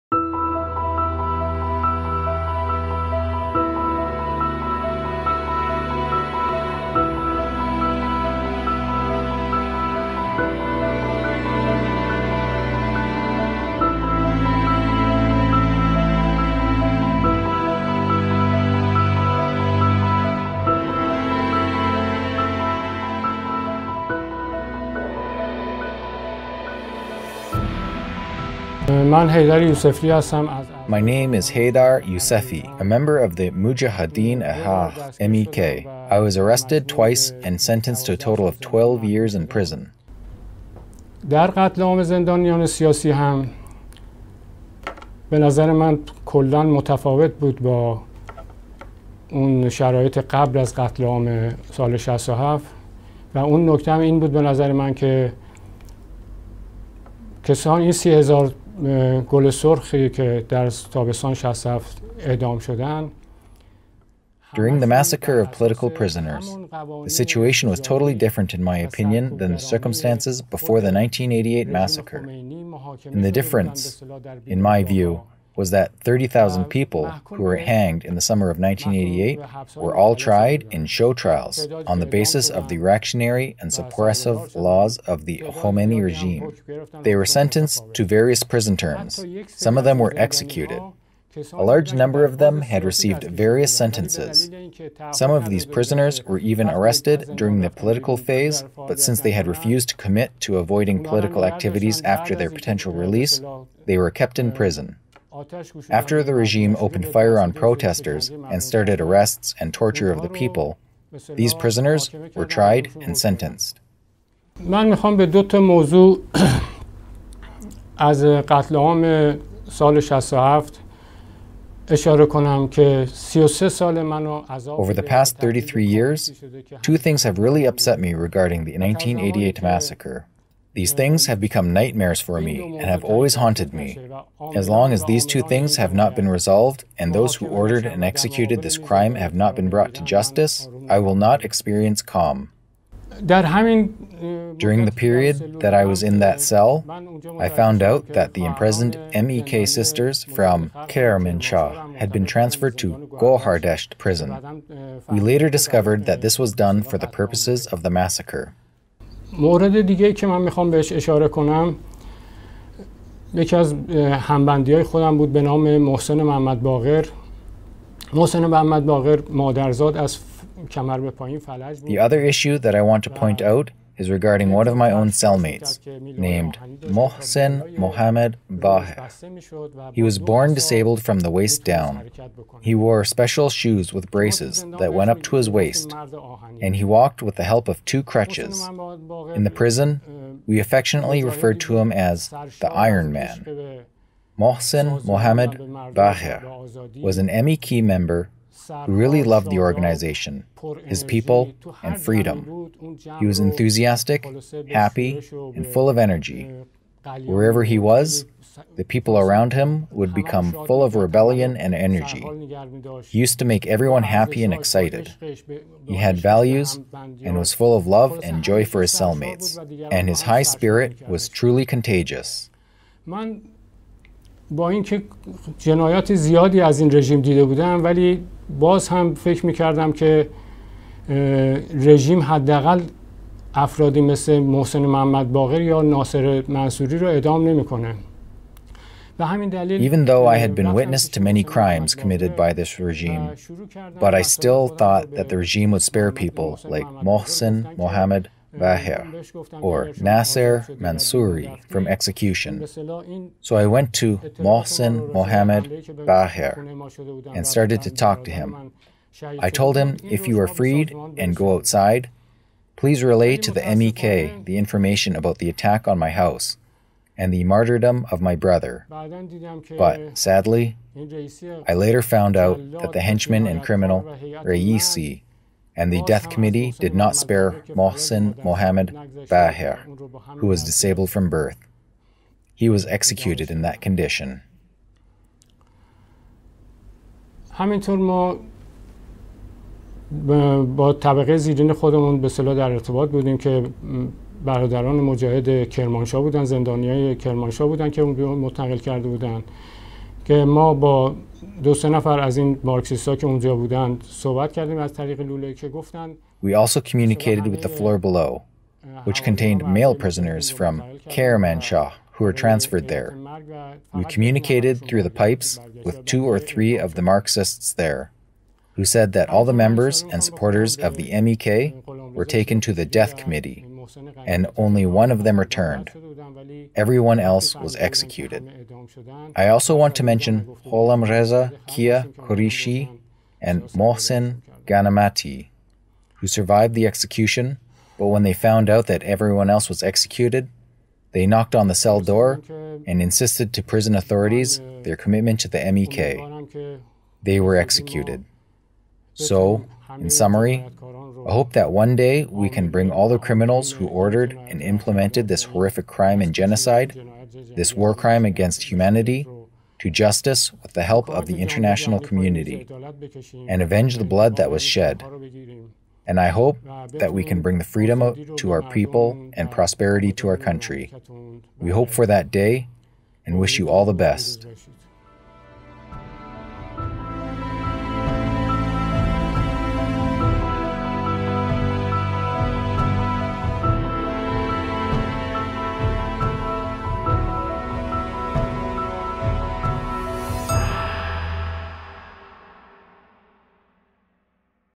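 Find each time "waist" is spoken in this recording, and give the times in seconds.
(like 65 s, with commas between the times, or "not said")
181 s, 185 s.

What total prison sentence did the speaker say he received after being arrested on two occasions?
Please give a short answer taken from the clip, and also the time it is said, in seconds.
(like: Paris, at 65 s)
12 years, at 38 s.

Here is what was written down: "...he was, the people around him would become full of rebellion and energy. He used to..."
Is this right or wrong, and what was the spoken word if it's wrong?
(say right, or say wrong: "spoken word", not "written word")
right.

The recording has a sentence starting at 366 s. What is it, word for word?
And I hope that we can bring the freedom to our people and prosperity to our country.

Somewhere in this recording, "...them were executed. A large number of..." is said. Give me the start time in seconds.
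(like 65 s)
89 s.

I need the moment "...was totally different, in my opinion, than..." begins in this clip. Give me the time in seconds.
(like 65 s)
67 s.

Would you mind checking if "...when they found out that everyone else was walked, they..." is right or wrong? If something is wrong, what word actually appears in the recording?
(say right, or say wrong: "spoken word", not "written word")
wrong: "executed", not "walked".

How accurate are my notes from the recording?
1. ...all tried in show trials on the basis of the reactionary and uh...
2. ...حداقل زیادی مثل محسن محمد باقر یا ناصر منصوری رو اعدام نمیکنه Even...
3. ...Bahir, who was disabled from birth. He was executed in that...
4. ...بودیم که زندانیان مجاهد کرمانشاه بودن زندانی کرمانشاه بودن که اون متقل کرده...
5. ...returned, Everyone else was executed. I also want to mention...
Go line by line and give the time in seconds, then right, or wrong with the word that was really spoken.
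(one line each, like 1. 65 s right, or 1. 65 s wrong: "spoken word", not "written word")
1. 79 s right
2. 232 s wrong: "افرادی", not "زیادی"
3. 279 s right
4. 293 s wrong: "برادران", not "زندانیان"
5. 325 s right.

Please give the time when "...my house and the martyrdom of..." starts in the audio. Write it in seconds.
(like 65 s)
265 s.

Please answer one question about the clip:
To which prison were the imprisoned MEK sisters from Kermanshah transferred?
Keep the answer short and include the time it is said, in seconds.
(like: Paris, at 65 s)
Gohardesht prison, at 153 s.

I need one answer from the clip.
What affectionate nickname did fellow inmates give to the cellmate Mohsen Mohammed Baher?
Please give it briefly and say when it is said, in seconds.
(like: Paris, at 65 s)
Iron Man, at 192 s.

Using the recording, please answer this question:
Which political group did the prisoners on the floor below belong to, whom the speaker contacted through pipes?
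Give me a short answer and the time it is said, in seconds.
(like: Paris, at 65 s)
Marxists, at 317 s.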